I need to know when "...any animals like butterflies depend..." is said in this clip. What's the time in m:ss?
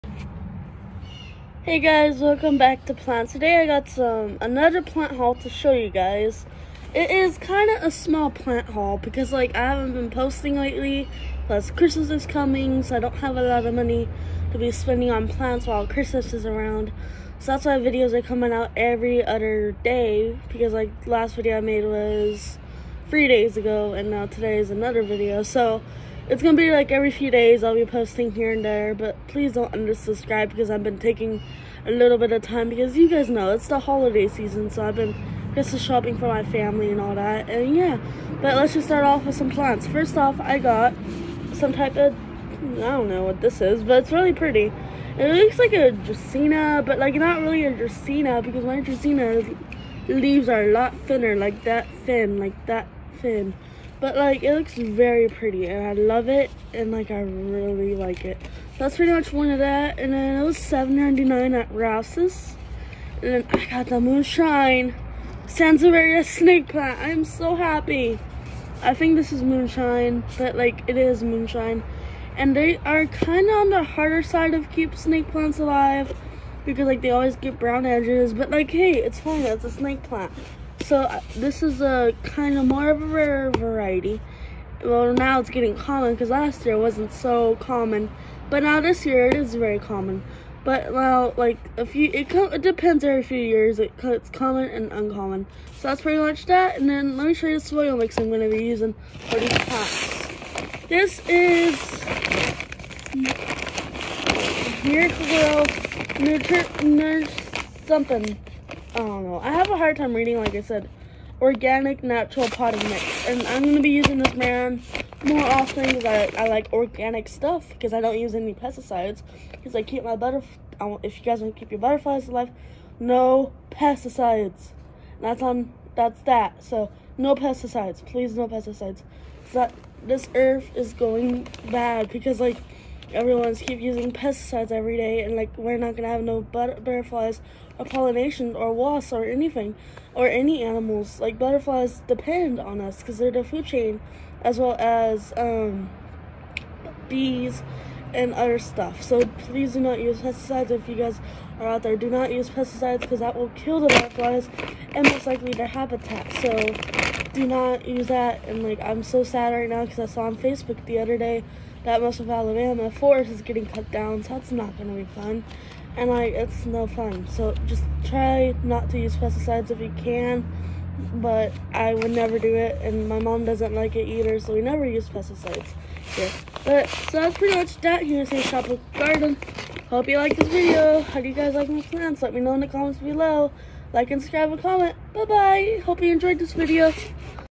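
2:20.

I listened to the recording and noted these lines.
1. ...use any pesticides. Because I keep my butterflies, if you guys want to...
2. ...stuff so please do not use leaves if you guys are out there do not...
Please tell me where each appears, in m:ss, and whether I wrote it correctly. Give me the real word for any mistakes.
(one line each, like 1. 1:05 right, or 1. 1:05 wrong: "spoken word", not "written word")
1. 1:58 right
2. 2:28 wrong: "pesticides", not "leaves".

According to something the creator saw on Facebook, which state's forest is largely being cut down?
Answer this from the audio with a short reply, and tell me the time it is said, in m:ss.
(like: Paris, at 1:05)
Alabama, at 2:42.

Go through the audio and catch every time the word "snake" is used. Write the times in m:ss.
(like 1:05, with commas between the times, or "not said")
1:06, 1:14, 1:19.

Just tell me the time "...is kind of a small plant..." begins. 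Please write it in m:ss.
0:07.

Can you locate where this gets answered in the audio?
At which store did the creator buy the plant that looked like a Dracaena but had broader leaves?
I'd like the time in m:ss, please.
1:01.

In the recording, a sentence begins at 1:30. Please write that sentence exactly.
But now, like a few, it, it depends every few years.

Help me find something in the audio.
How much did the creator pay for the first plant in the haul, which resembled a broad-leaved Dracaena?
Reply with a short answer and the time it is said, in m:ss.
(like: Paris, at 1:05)
$7.99, at 1:00.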